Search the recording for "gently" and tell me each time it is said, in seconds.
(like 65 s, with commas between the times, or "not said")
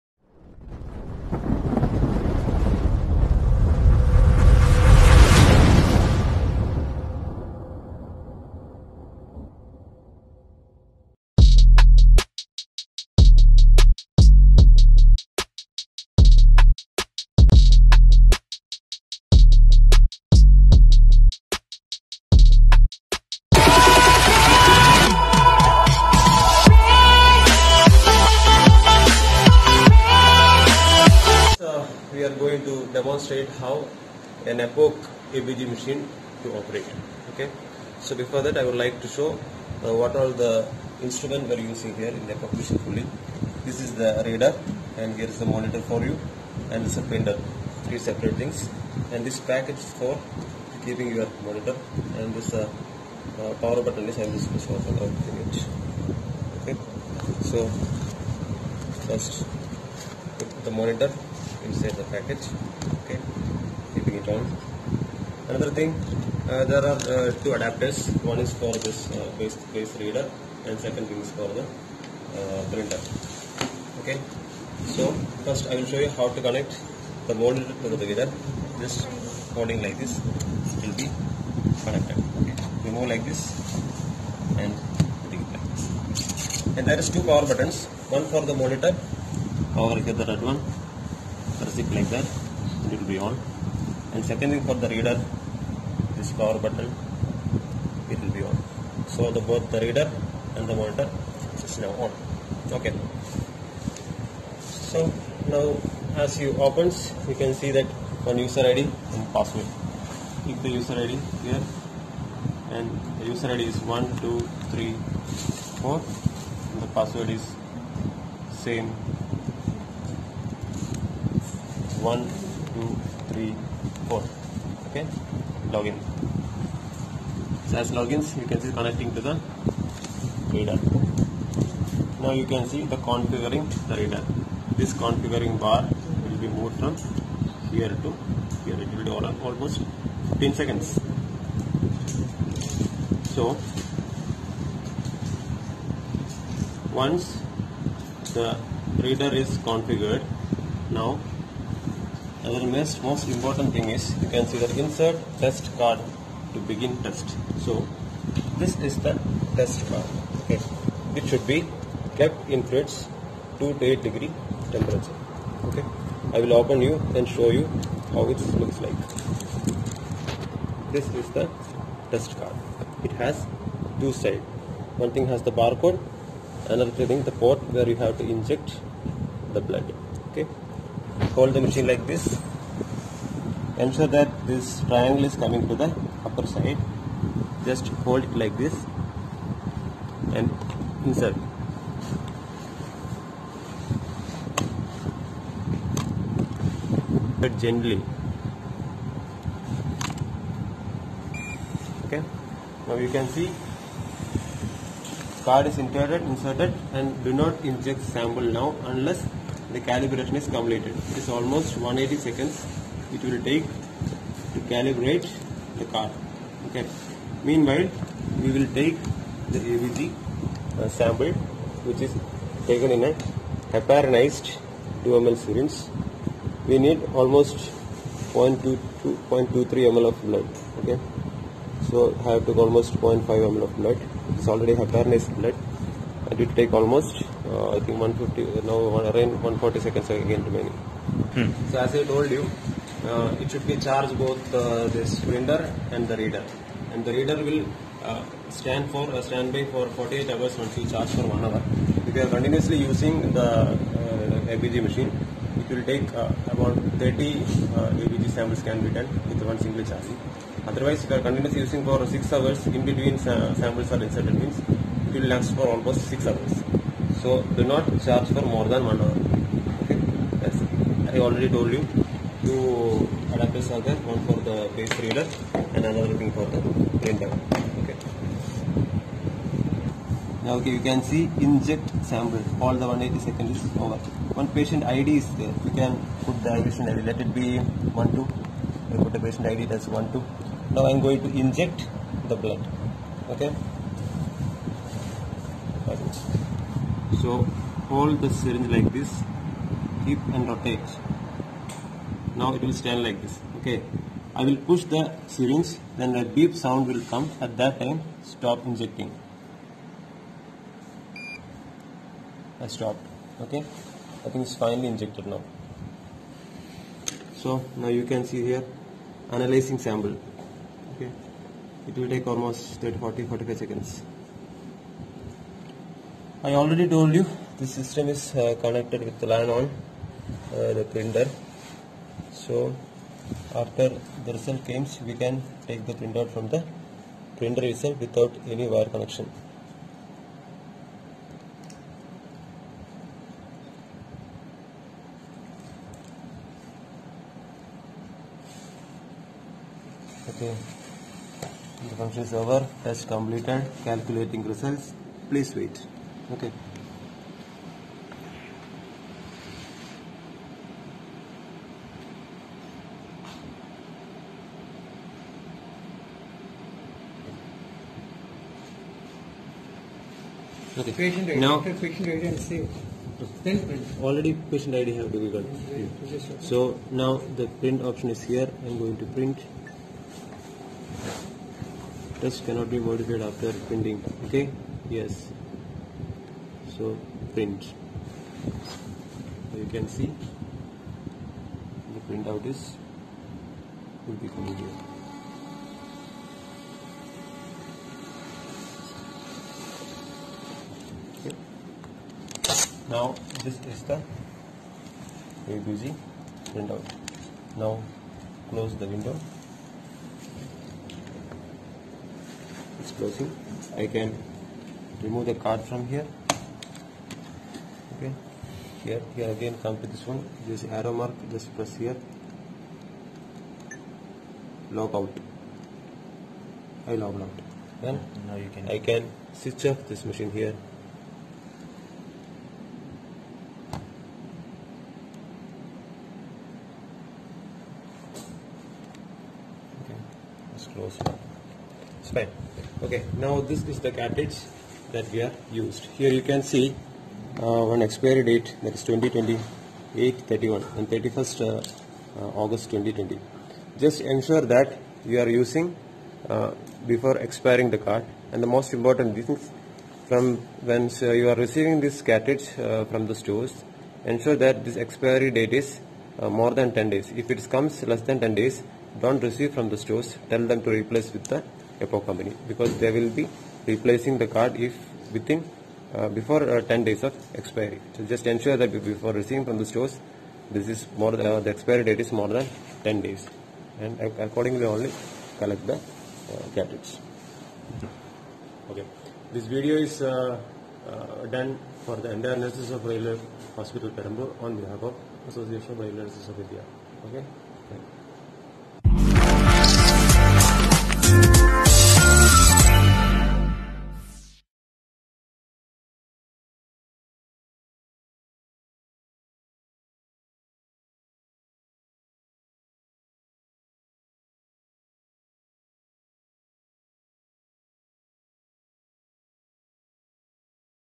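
197 s.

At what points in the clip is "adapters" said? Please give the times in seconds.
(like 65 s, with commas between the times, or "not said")
67 s, 273 s.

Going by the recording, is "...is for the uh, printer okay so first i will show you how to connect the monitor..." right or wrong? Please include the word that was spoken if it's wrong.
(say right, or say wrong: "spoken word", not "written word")
right.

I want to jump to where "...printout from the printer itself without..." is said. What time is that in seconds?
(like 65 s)
335 s.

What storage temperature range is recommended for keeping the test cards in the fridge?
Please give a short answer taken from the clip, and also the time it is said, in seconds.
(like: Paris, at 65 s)
2 to 8 degrees, at 163 s.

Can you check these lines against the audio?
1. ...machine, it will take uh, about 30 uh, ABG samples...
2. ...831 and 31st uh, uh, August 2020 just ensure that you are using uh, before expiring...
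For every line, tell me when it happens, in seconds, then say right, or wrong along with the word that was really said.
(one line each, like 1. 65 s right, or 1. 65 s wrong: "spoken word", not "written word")
1. 254 s right
2. 449 s right.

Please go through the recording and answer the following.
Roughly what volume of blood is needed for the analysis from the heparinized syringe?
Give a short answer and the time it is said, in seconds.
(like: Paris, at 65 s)
0.22 to 0.23 ml, at 227 s.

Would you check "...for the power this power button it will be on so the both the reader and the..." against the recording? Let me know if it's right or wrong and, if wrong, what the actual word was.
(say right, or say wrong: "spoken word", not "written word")
wrong: "reader", not "power".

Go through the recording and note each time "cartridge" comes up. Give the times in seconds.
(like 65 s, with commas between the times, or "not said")
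444 s, 462 s.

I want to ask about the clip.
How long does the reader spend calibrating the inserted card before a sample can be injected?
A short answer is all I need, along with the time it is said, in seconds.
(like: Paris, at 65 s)
180 seconds, at 211 s.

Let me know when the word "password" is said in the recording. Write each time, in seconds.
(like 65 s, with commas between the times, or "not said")
109 s, 116 s.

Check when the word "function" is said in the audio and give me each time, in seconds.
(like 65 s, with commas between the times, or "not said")
352 s.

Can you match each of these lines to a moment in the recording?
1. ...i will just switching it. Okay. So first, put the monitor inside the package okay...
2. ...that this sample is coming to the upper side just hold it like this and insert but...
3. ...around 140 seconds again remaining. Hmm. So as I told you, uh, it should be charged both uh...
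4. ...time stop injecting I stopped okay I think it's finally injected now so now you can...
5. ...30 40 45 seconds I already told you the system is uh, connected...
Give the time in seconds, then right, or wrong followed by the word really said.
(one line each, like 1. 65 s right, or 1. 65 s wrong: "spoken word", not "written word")
1. 54 s right
2. 184 s wrong: "triangle", not "sample"
3. 238 s right
4. 307 s right
5. 322 s right.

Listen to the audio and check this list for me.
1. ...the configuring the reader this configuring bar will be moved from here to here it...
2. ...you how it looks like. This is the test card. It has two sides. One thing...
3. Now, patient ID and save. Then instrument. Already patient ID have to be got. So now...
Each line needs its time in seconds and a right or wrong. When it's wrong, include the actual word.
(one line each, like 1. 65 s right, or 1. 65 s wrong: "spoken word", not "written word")
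1. 132 s right
2. 167 s right
3. 371 s wrong: "print", not "instrument".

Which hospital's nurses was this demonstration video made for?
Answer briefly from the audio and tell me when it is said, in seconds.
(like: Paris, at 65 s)
Railway Hospital Perambur, at 492 s.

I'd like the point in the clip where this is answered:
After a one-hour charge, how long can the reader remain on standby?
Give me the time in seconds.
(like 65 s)
249 s.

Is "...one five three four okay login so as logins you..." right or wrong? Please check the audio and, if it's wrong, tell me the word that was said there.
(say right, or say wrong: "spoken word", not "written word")
wrong: "two", not "five".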